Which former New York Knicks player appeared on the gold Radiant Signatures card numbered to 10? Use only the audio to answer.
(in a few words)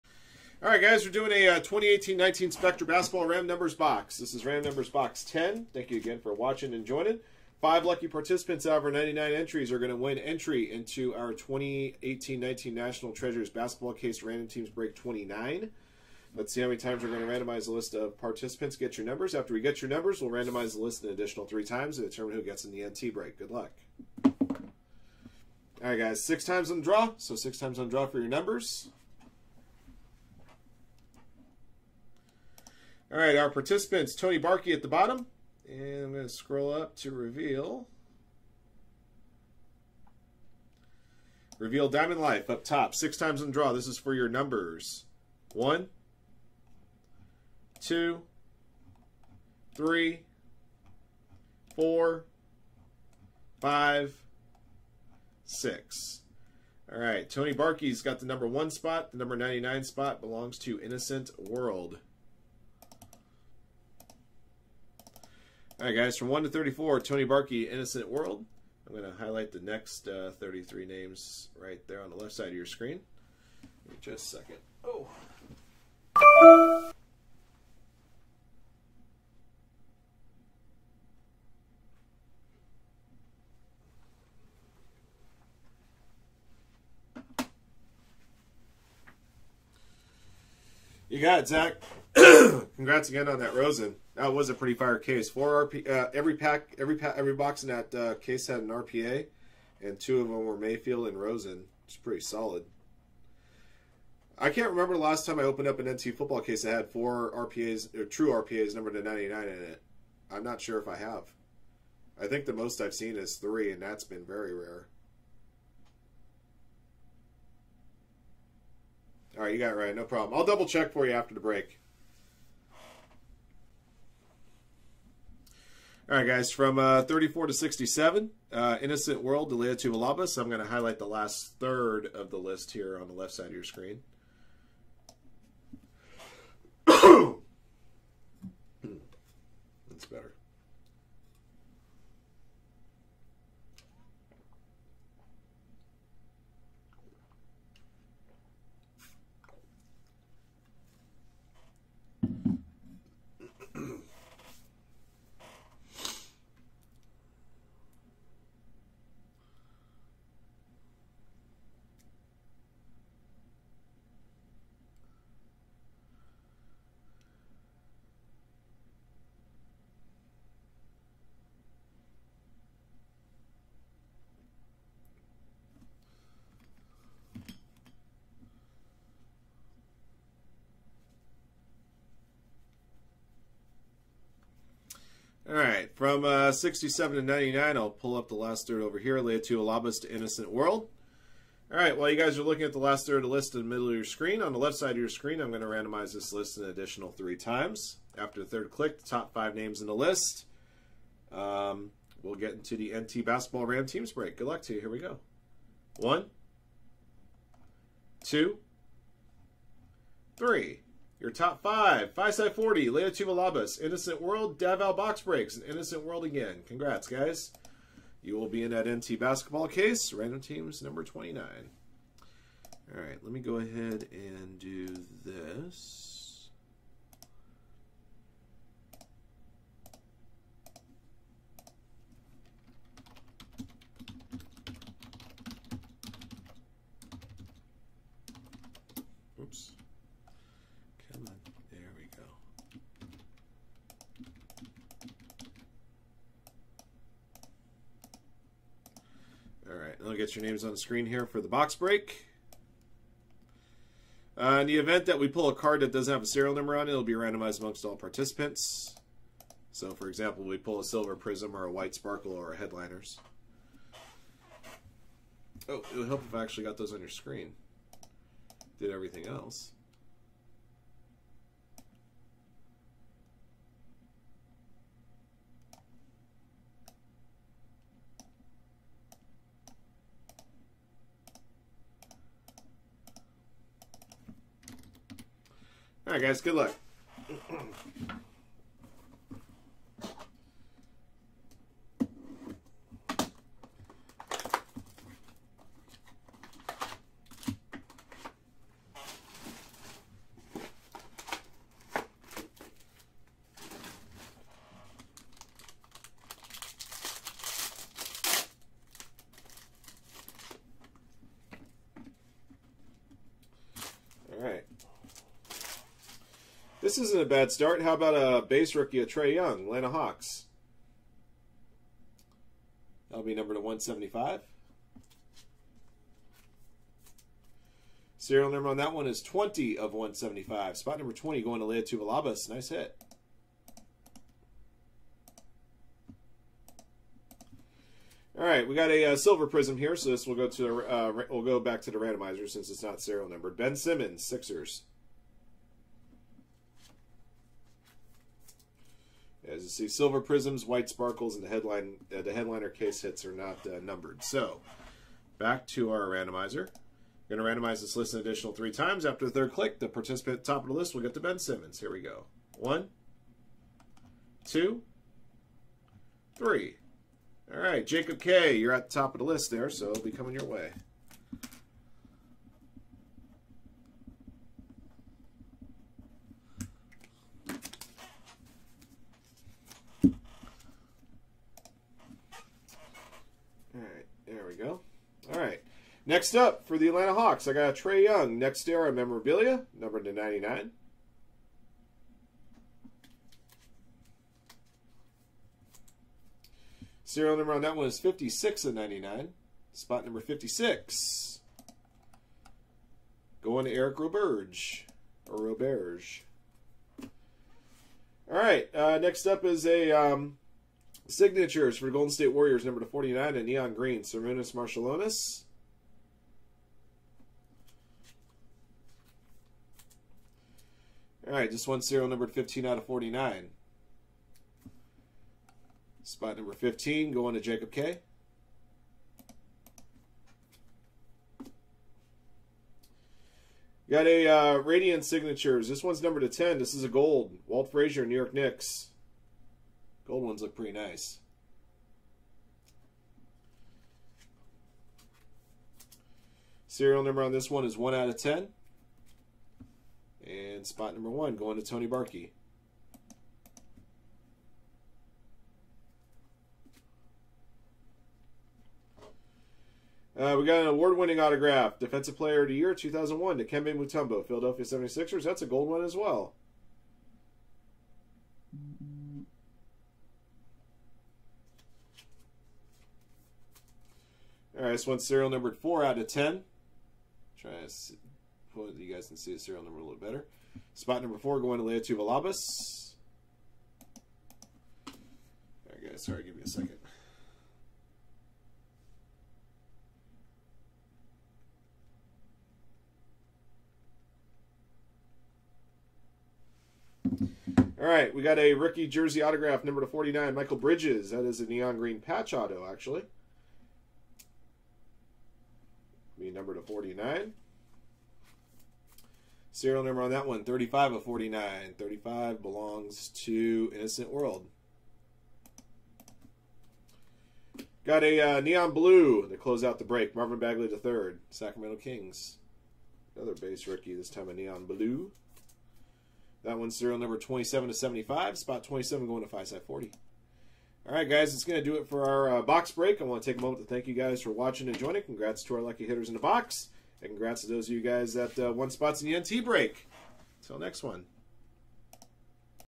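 Walt Frazier.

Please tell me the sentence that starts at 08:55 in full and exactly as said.
Congrats to our lucky hitters in the box.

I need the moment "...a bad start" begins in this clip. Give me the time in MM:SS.
05:17.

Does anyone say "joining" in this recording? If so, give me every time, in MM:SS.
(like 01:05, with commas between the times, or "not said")
00:06, 08:54.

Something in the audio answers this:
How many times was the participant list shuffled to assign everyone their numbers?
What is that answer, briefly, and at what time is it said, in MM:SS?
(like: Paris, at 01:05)
6, at 00:42.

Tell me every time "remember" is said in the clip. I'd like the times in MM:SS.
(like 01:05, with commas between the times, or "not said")
01:44.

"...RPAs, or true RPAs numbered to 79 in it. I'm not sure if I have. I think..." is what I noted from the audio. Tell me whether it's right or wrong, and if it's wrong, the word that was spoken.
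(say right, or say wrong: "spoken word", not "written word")
wrong: "99", not "79".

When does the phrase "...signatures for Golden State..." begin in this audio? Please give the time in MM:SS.
06:51.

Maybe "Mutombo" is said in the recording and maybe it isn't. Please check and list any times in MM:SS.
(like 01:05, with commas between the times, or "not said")
07:43.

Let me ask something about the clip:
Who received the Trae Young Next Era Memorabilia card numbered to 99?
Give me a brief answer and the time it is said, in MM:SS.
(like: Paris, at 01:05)
Eric Roberge, at 06:43.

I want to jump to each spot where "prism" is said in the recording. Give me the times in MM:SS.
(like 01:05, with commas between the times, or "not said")
04:21, 05:39, 05:50.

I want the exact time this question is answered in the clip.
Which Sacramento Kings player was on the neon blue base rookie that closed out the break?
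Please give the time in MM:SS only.
08:40.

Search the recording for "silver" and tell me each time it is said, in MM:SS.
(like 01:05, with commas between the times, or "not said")
04:20, 05:39, 05:49.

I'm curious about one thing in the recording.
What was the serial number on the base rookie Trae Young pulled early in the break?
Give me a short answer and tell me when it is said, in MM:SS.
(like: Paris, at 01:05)
20 of 175, at 05:29.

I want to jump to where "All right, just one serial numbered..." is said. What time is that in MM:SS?
07:01.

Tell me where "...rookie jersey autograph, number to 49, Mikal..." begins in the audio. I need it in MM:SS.
08:18.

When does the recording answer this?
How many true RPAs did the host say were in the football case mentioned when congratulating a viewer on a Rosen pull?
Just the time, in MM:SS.
01:35.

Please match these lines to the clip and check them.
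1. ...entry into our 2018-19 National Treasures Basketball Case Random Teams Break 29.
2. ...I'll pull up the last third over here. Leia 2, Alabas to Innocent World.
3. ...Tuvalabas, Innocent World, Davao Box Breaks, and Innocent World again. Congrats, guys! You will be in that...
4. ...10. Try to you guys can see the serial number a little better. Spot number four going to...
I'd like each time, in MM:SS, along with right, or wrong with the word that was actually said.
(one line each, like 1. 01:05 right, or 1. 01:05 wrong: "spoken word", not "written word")
1. 00:10 right
2. 03:07 right
3. 03:33 right
4. 07:56 right.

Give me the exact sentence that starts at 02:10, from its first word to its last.
So I'm going to highlight the last third of the list here on the left side of your screen.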